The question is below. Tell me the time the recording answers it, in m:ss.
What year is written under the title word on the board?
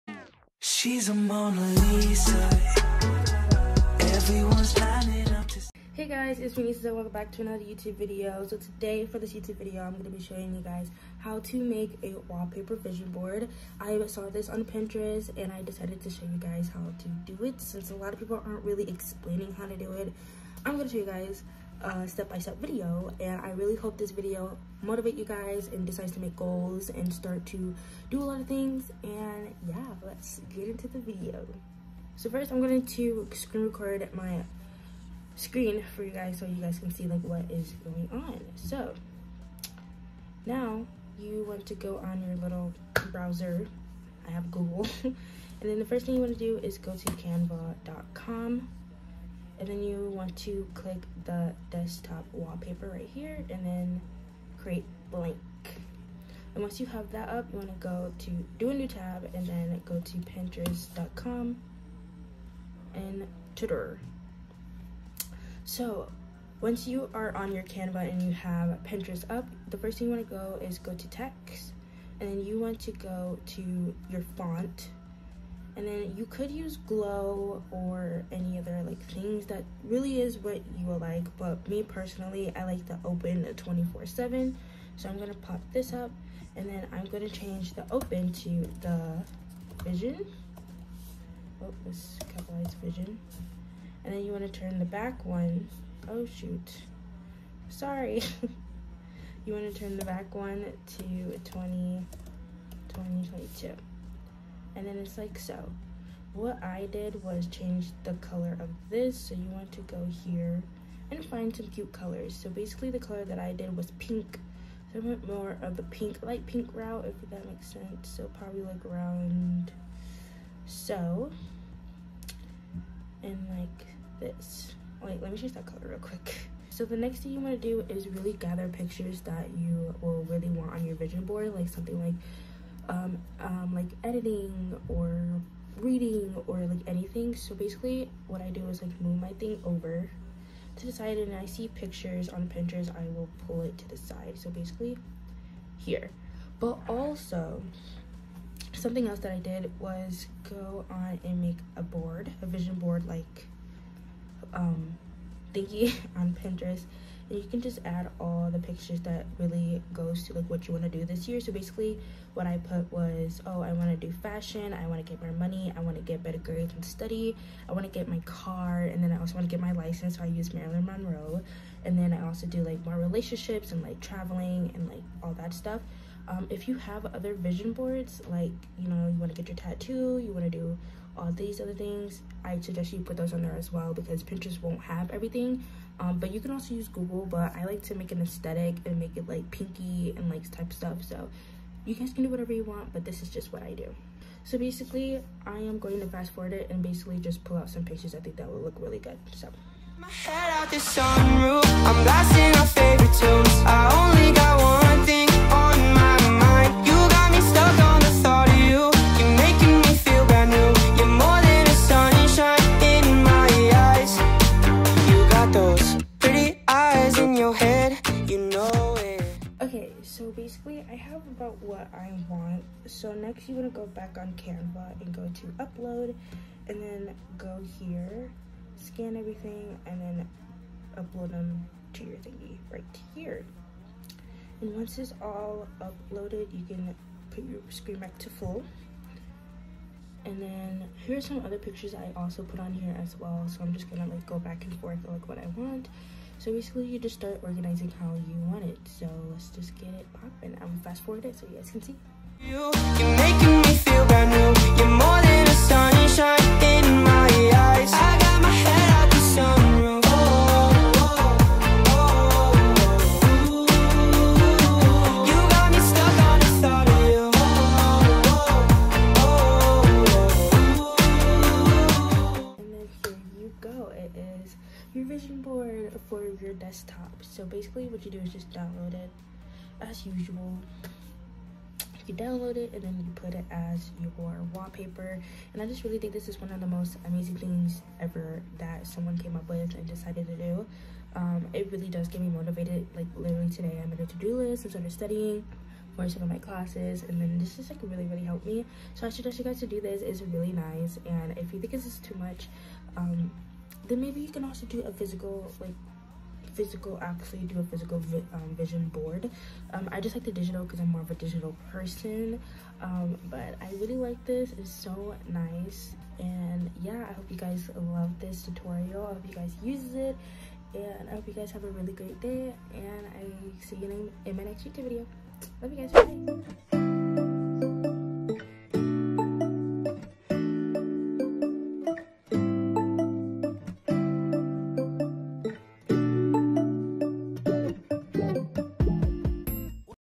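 1:42.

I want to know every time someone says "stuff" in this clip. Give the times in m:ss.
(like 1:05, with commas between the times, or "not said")
2:55, 3:10.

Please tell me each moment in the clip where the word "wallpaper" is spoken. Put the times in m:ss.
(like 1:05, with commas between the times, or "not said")
0:12, 0:52, 4:44.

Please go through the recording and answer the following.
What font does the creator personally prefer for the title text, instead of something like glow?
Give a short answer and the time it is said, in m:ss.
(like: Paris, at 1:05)
Open 24 7, at 1:23.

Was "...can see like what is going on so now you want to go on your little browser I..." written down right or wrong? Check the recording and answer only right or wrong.
right.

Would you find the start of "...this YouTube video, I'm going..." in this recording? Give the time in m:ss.
0:09.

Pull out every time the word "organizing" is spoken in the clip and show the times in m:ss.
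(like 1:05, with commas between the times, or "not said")
4:07.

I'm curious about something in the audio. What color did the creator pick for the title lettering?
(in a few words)
light pink.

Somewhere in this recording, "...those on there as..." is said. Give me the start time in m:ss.
3:03.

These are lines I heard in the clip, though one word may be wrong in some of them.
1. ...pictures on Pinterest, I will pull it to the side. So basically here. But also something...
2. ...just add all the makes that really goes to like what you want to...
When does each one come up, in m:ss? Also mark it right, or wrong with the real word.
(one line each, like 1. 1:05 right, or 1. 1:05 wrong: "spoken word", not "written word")
1. 2:21 right
2. 2:37 wrong: "pictures", not "makes".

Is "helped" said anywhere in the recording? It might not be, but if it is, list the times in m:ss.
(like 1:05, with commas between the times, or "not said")
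4:58.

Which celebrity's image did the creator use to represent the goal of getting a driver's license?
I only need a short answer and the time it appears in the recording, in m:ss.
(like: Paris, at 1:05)
Marilyn Monroe, at 2:50.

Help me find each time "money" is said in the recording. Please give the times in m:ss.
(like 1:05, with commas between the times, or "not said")
2:45.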